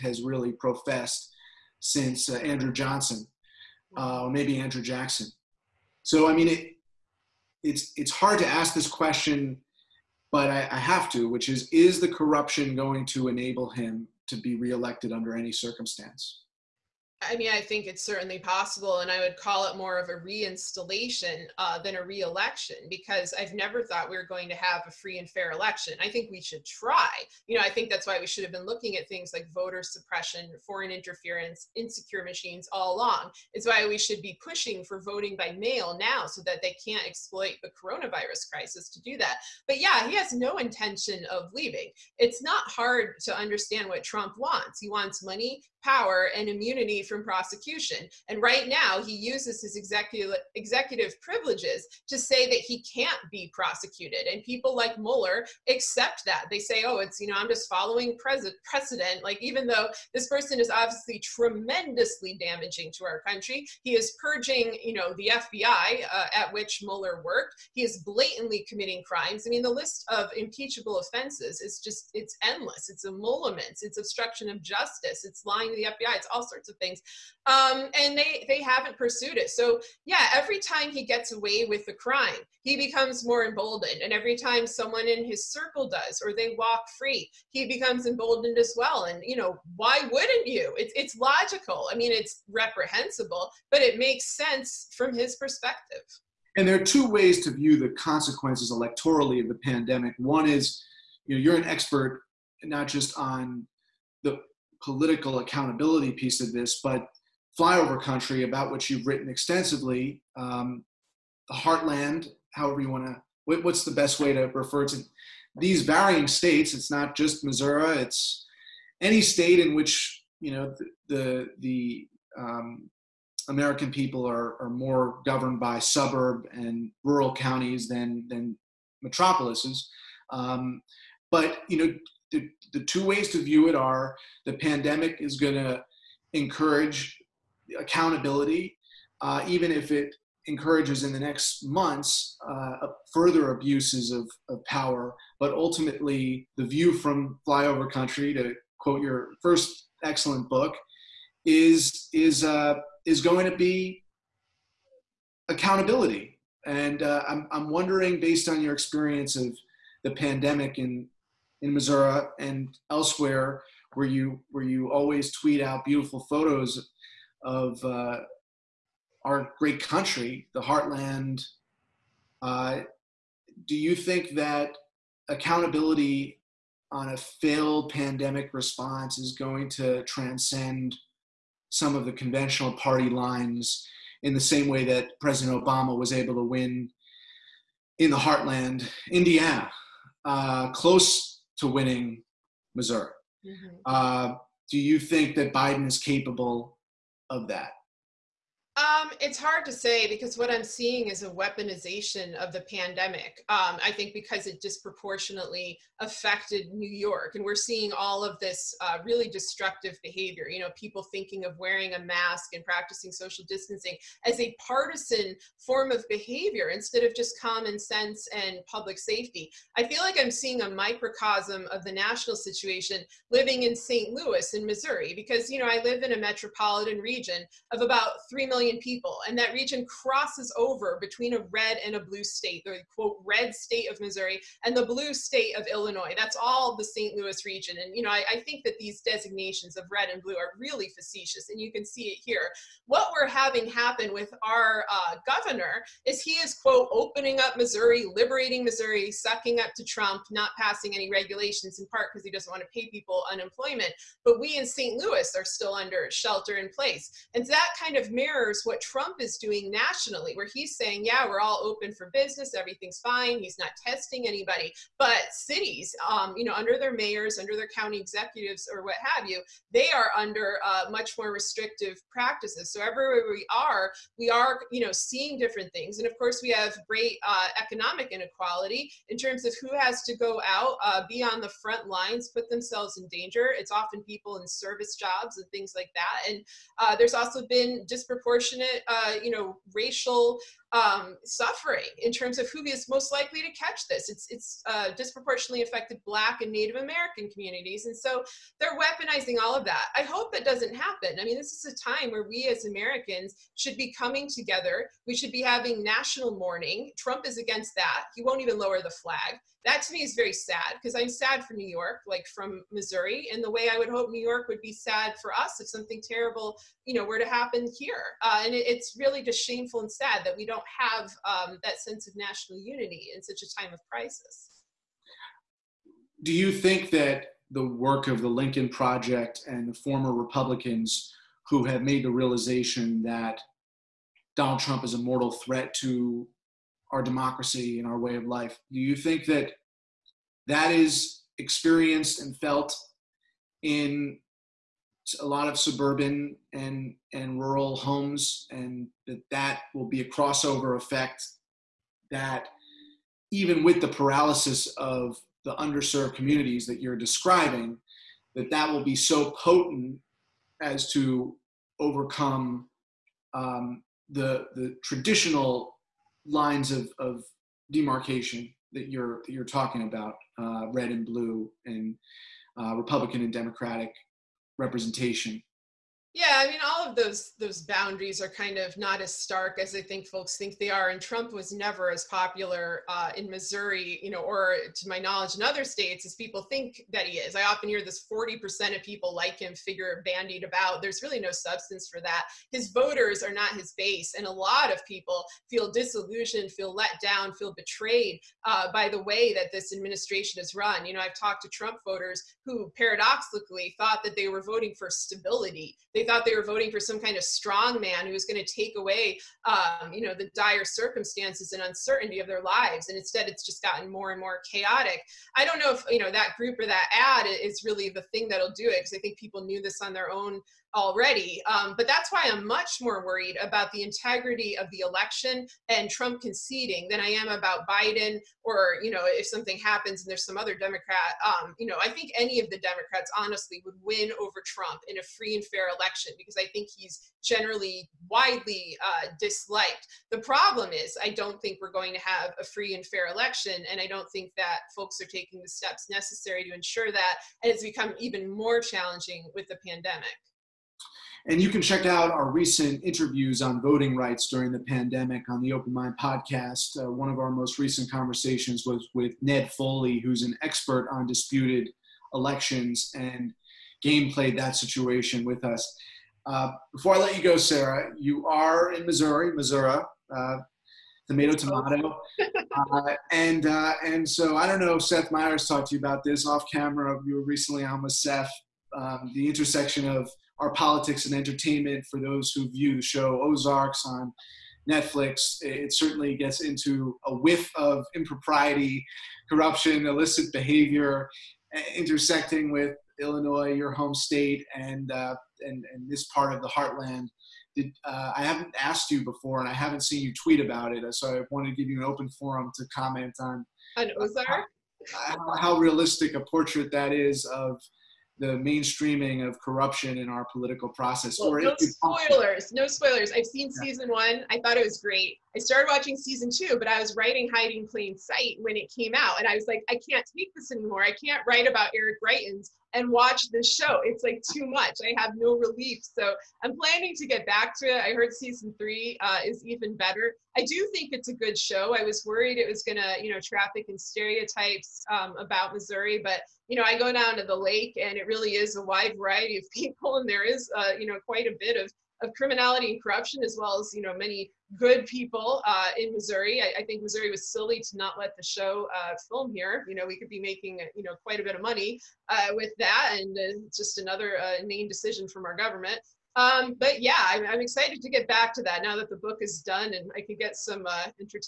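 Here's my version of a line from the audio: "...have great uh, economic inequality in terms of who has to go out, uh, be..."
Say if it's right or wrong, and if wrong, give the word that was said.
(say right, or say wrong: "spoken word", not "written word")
right.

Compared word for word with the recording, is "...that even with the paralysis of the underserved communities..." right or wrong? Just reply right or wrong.
right.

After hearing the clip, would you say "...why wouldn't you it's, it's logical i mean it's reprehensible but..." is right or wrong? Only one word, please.
right.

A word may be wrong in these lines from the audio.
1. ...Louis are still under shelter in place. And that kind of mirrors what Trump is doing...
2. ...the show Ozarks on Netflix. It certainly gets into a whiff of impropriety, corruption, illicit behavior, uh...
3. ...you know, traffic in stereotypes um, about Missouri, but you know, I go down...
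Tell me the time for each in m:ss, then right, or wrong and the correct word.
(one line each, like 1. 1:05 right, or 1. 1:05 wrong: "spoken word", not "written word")
1. 4:15 right
2. 8:02 right
3. 8:53 right.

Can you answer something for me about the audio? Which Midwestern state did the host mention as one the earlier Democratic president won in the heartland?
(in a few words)
Indiana.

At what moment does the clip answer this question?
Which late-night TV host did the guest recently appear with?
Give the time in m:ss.
7:54.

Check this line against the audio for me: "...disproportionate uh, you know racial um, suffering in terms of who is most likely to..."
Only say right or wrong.
right.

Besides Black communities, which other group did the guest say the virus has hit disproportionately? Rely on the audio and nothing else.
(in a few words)
Native American.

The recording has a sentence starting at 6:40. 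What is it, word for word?
You know, I've talked to Trump voters who paradoxically thought that they were voting for stability.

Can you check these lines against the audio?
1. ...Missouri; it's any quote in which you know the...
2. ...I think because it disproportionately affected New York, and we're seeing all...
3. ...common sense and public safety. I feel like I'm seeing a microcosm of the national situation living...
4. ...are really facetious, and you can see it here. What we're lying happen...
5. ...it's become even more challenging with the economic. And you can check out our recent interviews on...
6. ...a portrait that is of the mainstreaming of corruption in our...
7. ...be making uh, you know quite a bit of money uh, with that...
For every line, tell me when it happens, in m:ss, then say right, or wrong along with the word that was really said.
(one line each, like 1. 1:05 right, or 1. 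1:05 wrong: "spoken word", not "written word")
1. 1:57 wrong: "state", not "quote"
2. 3:23 right
3. 3:37 right
4. 4:00 wrong: "having", not "lying"
5. 7:27 wrong: "pandemic", not "economic"
6. 8:26 right
7. 9:10 right.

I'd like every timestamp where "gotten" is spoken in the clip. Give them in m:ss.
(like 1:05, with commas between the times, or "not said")
6:53.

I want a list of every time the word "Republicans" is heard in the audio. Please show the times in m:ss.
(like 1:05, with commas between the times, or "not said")
5:30, 6:12.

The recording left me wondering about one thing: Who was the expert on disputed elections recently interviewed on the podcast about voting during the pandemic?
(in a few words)
Ned Foley.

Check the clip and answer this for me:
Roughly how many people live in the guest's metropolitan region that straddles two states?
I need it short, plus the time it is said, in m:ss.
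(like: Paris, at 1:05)
3 million, at 3:48.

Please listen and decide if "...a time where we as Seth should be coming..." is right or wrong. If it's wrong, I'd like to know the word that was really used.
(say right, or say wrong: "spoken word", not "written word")
wrong: "Americans", not "Seth".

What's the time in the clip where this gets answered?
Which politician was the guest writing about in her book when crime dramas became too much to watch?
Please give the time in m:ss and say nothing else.
8:41.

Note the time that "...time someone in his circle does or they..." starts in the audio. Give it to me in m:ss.
1:24.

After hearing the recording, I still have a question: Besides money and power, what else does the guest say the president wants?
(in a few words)
Immunity from prosecution.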